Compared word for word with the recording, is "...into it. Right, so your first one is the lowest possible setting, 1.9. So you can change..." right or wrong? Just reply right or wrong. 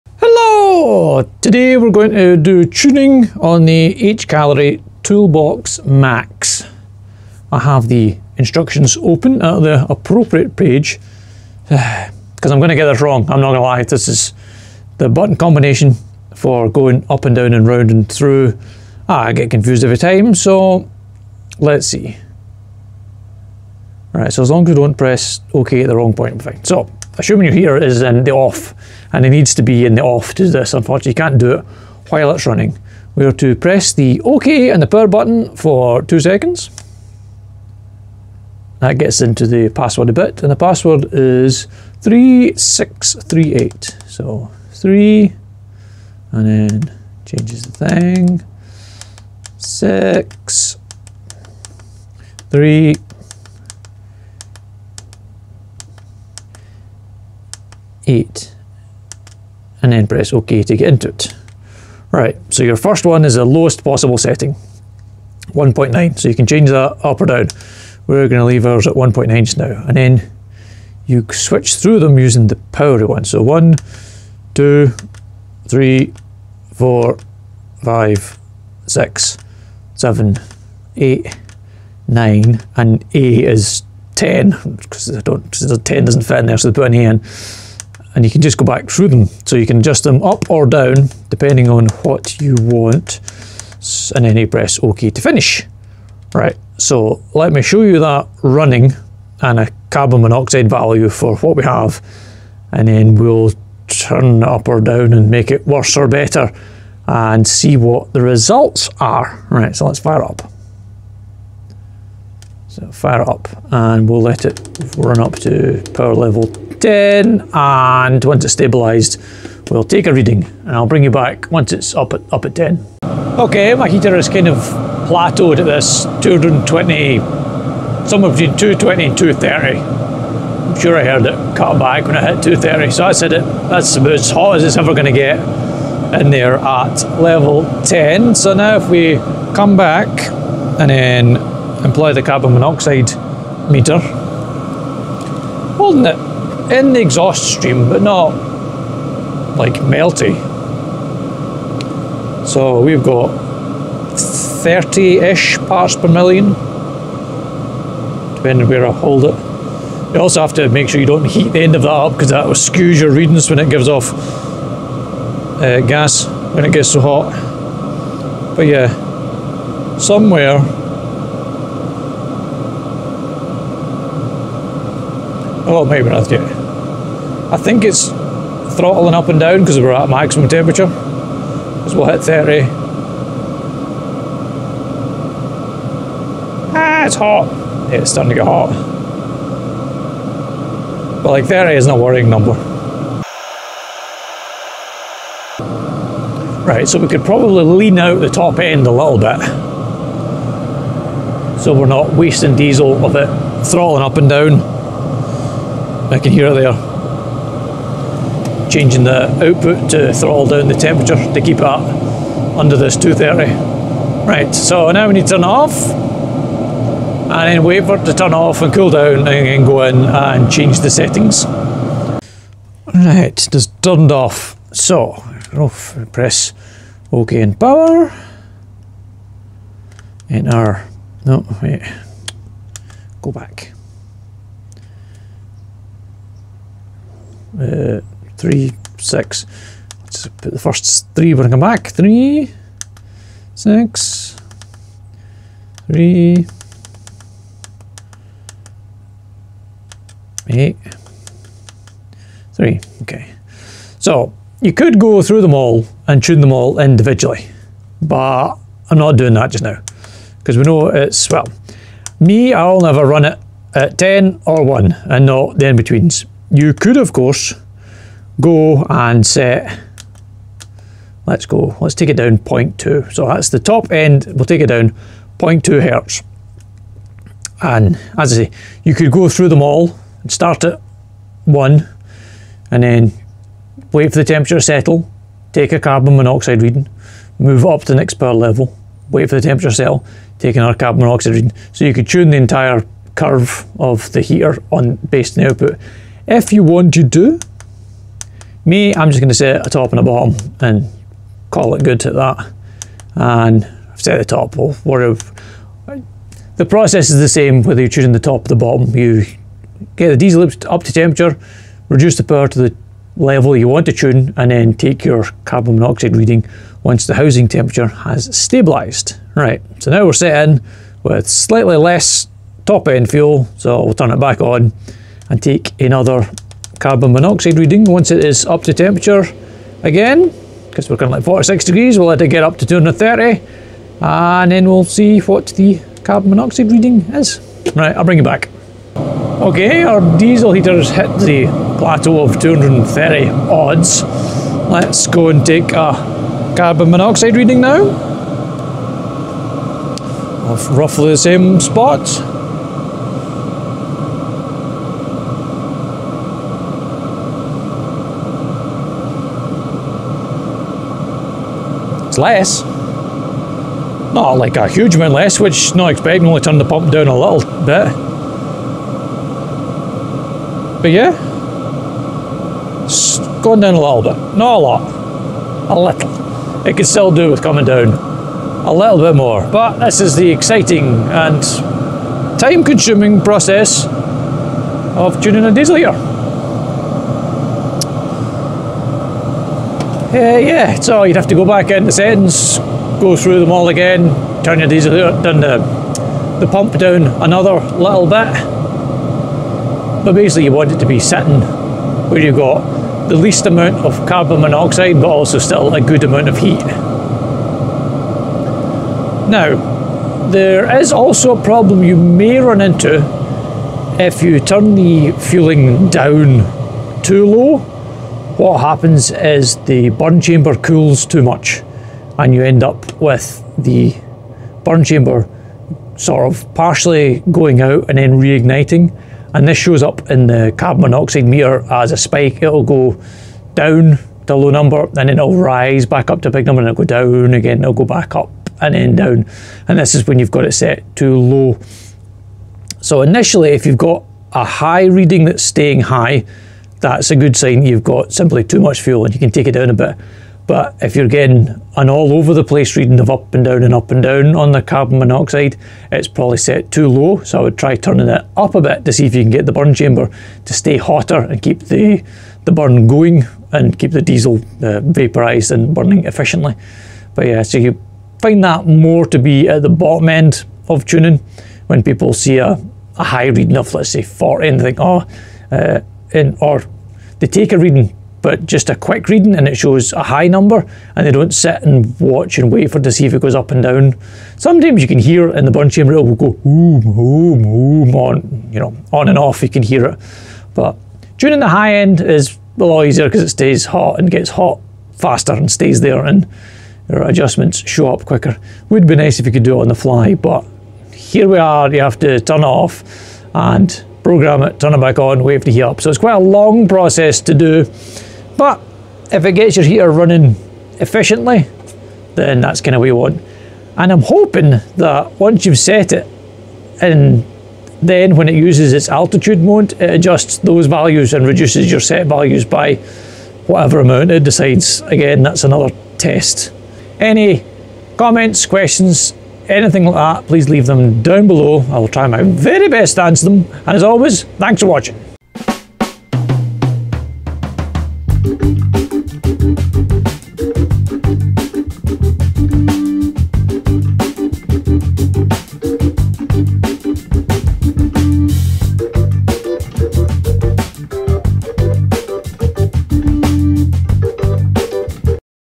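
right.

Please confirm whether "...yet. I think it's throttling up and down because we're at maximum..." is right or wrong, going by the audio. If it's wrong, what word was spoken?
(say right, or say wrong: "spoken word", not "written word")
right.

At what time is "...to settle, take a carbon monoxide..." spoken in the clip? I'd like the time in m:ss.
4:44.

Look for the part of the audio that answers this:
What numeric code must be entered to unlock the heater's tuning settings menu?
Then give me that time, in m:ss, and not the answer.
0:42.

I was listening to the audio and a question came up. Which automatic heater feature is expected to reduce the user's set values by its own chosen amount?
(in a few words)
Altitude mode.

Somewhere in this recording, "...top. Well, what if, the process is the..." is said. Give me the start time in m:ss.
5:04.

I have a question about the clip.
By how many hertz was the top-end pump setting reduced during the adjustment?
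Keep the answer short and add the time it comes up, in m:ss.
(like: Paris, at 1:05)
0.2, at 4:35.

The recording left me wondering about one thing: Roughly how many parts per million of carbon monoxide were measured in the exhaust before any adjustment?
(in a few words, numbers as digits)
30.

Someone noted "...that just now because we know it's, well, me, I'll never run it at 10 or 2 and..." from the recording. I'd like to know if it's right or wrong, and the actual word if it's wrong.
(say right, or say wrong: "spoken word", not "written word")
wrong: "1", not "2".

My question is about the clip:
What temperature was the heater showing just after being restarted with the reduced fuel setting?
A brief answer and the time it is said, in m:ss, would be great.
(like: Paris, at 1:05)
46 degrees, at 5:31.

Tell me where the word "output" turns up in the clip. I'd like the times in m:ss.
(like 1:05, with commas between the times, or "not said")
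3:29, 4:55.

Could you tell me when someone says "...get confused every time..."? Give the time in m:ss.
0:19.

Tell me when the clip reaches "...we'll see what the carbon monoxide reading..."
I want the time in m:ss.
5:34.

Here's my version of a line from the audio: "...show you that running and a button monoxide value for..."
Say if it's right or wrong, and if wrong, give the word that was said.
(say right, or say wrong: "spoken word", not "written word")
wrong: "carbon", not "button".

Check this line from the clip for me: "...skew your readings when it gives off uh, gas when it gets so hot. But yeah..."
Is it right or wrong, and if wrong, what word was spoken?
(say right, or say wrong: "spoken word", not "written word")
right.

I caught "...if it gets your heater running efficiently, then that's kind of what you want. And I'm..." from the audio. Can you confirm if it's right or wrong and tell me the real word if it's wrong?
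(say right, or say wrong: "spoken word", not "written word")
right.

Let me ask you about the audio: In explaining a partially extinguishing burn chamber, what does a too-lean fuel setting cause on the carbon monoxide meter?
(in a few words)
A spike.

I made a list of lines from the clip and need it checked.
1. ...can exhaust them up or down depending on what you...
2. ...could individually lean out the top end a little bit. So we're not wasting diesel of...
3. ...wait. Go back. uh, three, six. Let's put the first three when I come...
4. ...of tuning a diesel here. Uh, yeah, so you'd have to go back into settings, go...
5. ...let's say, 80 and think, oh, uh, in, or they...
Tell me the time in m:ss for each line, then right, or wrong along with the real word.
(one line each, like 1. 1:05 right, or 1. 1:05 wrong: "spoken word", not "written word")
1. 1:29 wrong: "adjust", not "exhaust"
2. 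3:17 wrong: "probably", not "individually"
3. 3:51 right
4. 6:23 right
5. 7:53 wrong: "40", not "80".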